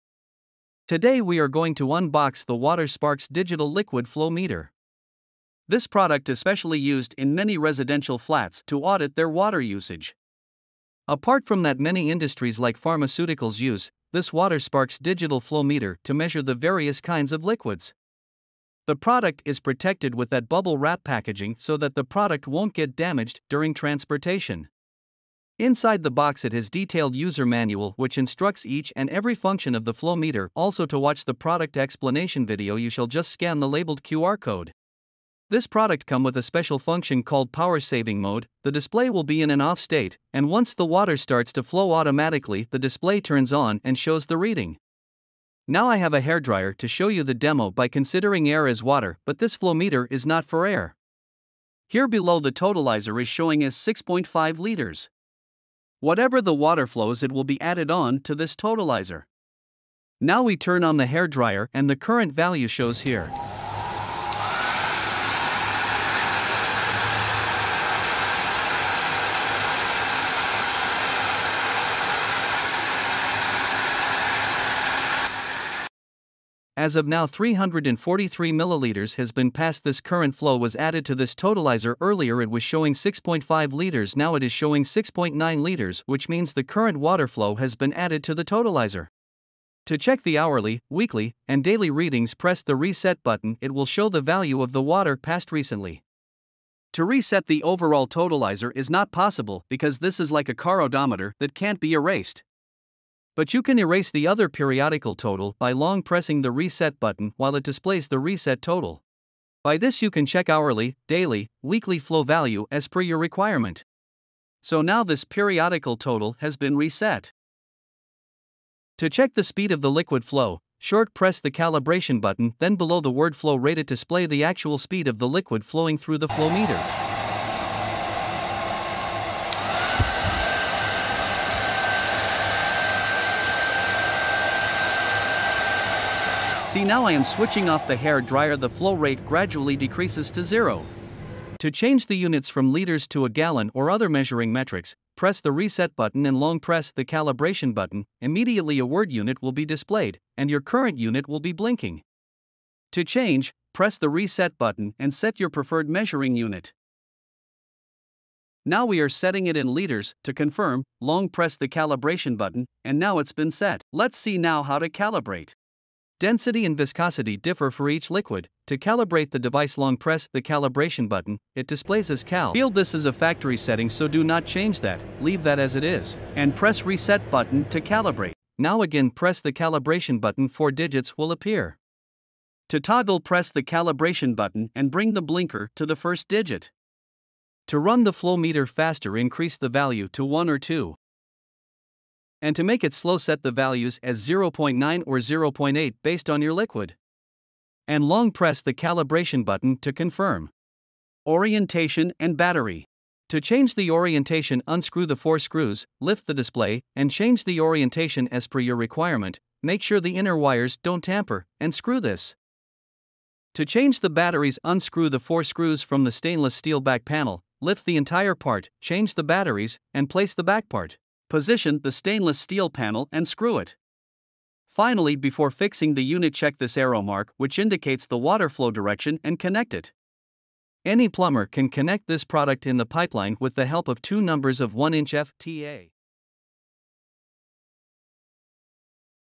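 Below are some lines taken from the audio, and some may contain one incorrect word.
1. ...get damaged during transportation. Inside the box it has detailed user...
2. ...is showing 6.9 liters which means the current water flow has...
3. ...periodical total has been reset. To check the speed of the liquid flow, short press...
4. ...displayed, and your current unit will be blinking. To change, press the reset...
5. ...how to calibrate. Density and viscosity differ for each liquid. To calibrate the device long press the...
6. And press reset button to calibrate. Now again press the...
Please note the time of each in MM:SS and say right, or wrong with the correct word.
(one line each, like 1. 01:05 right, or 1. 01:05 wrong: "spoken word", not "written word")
1. 00:22 right
2. 01:24 right
3. 01:55 right
4. 02:29 right
5. 02:44 right
6. 02:56 right.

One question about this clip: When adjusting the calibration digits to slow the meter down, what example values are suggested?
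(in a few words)
0.9 or 0.8.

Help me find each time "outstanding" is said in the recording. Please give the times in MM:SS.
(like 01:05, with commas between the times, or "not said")
not said.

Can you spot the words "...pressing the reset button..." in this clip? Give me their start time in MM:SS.
01:46.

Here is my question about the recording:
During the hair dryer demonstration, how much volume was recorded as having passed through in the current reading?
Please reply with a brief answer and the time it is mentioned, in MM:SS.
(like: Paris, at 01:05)
343 milliliters, at 01:17.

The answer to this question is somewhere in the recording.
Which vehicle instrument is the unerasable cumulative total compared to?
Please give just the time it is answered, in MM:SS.
01:40.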